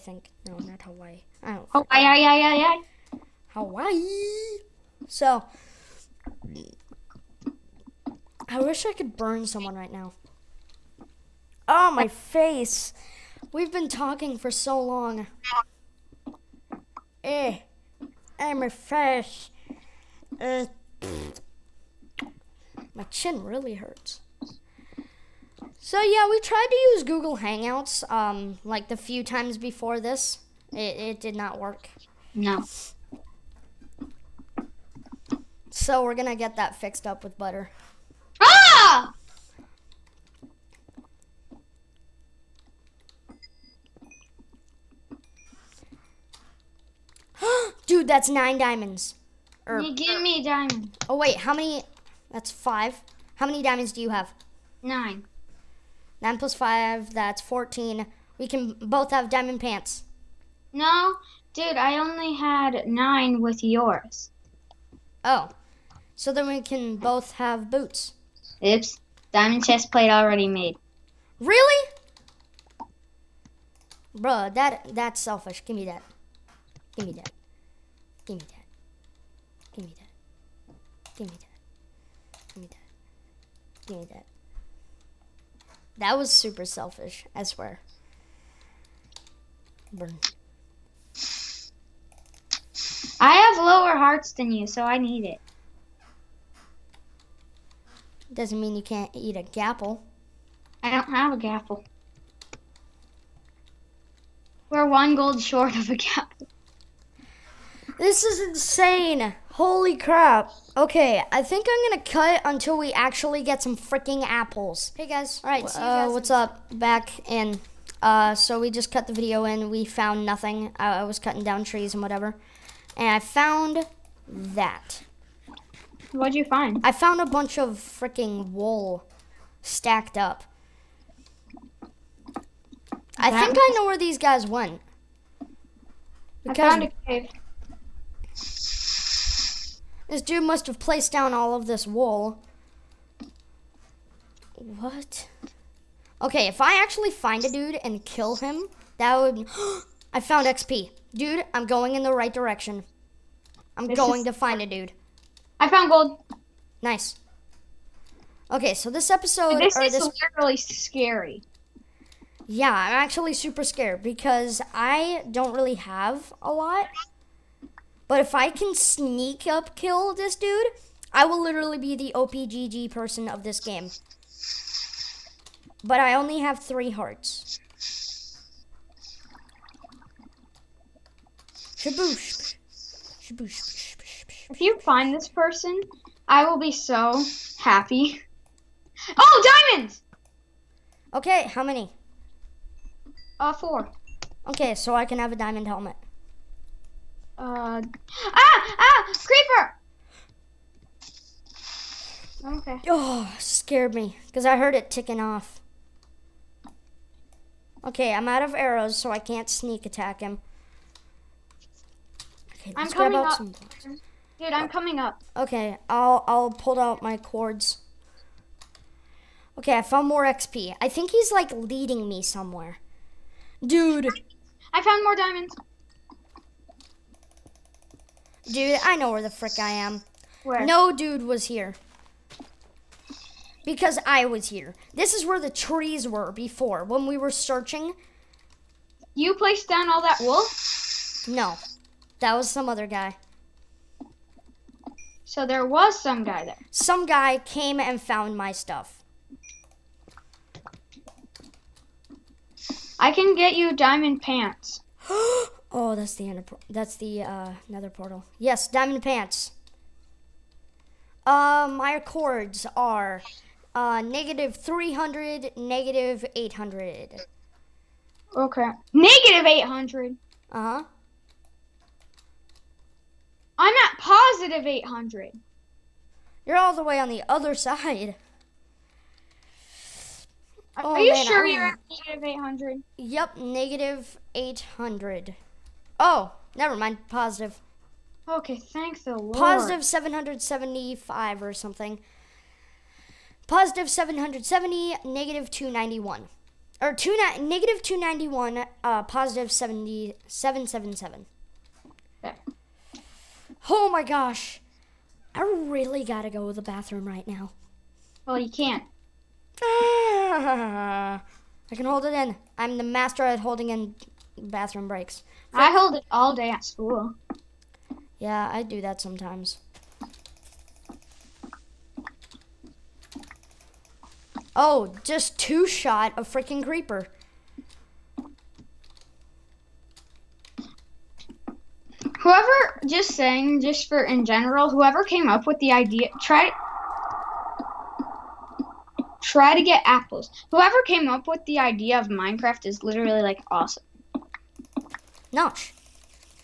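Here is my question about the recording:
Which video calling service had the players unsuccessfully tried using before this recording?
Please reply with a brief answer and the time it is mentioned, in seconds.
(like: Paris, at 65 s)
Google Hangouts, at 27 s.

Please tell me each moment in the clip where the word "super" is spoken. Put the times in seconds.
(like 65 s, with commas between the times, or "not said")
86 s, 163 s.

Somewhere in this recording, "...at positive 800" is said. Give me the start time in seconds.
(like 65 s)
273 s.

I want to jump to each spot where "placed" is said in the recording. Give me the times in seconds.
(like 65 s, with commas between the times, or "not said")
140 s, 239 s.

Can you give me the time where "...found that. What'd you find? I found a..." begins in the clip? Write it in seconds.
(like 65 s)
123 s.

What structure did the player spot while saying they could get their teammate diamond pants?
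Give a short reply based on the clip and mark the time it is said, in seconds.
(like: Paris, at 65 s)
nether portal, at 257 s.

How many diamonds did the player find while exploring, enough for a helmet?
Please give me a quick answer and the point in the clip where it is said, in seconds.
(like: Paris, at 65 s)
4, at 193 s.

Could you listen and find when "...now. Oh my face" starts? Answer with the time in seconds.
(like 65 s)
9 s.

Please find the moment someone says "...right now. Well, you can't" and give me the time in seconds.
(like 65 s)
307 s.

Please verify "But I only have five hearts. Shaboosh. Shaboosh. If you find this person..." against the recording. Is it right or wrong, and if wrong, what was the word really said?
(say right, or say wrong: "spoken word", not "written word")
wrong: "three", not "five".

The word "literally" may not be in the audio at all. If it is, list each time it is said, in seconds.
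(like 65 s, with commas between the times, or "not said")
160 s, 171 s, 342 s.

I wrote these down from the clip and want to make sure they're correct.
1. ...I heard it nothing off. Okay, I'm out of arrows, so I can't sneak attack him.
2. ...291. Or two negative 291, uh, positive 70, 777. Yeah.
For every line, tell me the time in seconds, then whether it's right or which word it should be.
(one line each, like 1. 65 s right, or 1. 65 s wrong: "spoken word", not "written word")
1. 204 s wrong: "ticking", not "nothing"
2. 295 s right.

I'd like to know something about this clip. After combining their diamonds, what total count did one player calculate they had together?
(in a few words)
14.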